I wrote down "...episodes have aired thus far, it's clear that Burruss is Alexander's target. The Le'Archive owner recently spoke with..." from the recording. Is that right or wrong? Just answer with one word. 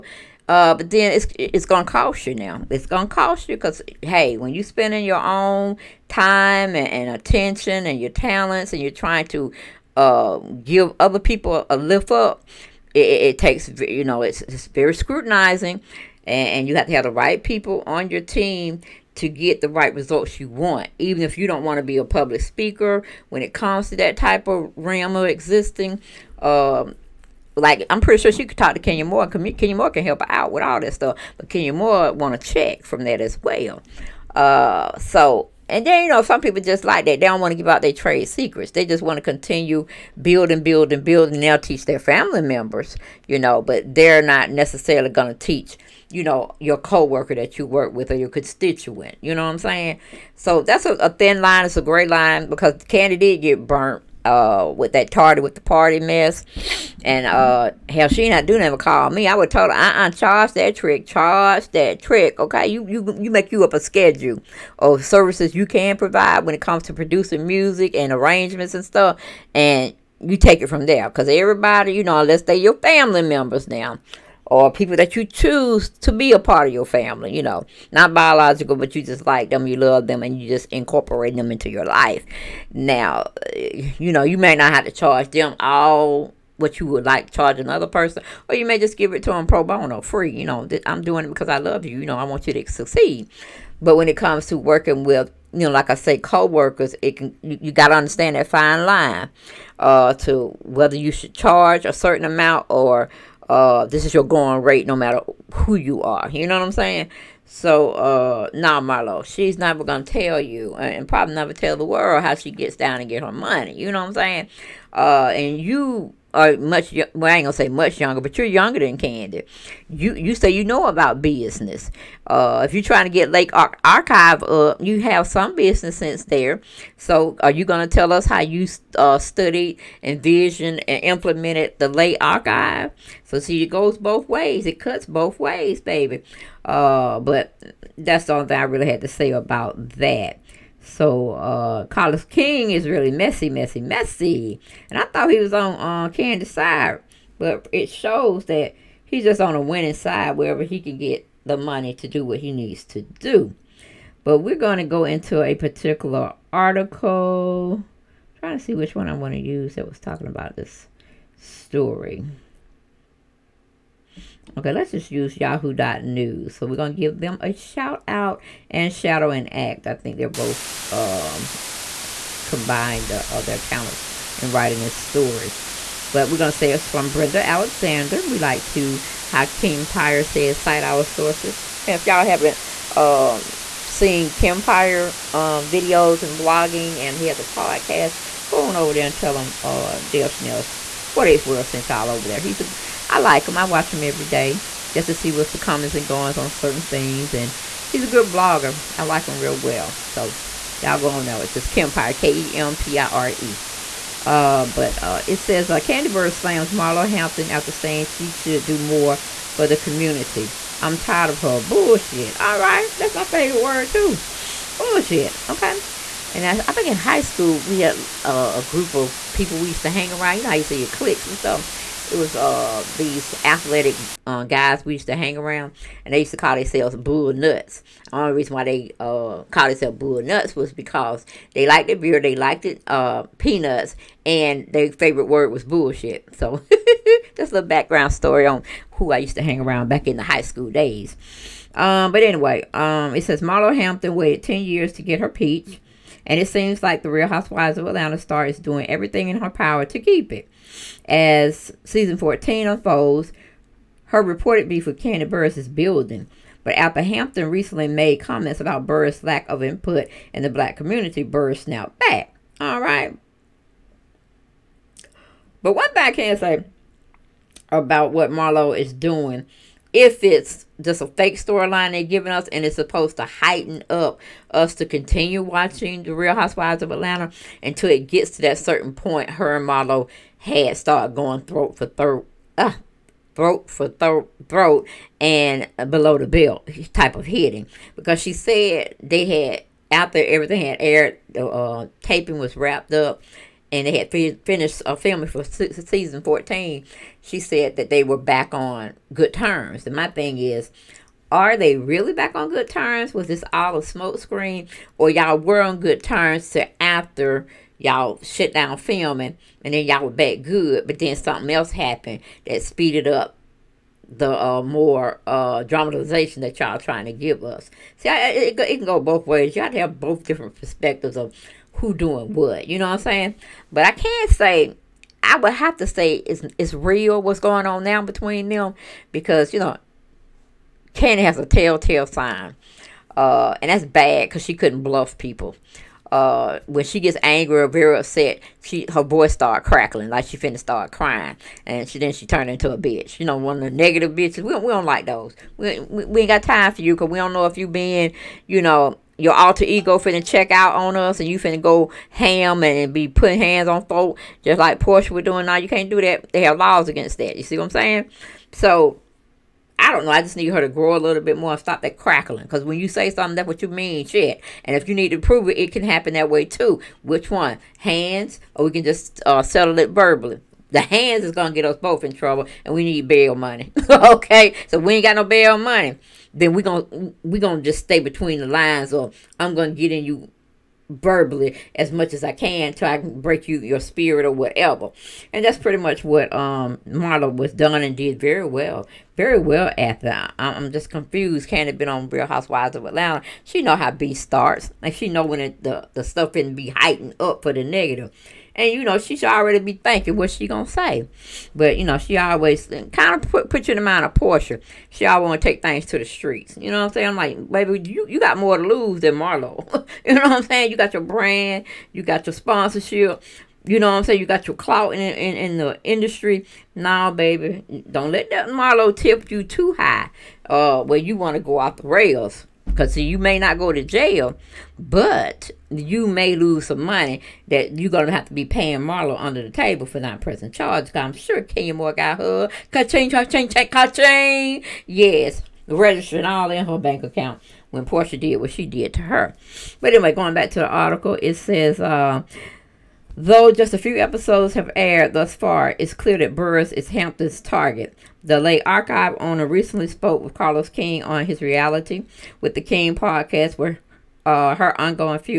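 wrong.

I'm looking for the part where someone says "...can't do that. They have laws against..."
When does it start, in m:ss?
5:55.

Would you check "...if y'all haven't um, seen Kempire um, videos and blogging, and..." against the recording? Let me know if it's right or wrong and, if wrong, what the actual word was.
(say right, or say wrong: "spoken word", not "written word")
right.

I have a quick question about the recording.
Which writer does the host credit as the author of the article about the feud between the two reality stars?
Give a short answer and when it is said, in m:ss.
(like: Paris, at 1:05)
Brenda Alexander, at 2:57.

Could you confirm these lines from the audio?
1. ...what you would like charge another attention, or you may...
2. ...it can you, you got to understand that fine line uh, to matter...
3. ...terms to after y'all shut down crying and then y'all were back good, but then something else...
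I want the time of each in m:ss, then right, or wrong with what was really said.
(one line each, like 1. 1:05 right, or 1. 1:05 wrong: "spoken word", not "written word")
1. 1:26 wrong: "person", not "attention"
2. 1:37 wrong: "whether", not "matter"
3. 5:06 wrong: "filming", not "crying".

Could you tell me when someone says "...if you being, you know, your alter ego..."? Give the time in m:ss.
5:47.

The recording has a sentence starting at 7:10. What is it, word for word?
I'm sure Kenya Moore got her.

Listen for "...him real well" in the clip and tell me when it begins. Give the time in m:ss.
3:19.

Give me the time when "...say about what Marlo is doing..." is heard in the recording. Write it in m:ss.
4:26.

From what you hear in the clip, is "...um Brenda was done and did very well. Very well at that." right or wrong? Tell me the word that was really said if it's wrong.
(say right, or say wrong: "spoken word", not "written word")
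wrong: "Marla", not "Brenda".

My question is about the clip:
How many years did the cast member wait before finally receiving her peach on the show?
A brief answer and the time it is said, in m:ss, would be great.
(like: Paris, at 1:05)
10, at 4:04.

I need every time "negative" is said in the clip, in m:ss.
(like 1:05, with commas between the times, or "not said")
5:43, 6:37.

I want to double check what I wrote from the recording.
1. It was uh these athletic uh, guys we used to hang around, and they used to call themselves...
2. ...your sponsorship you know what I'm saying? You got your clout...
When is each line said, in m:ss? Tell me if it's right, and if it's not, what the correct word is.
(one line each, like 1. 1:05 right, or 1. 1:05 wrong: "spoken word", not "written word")
1. 3:42 right
2. 6:52 right.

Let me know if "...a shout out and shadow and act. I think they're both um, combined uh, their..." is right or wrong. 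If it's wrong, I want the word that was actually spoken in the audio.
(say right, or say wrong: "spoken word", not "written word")
right.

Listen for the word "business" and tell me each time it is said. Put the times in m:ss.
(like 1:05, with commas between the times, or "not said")
2:01, 2:05.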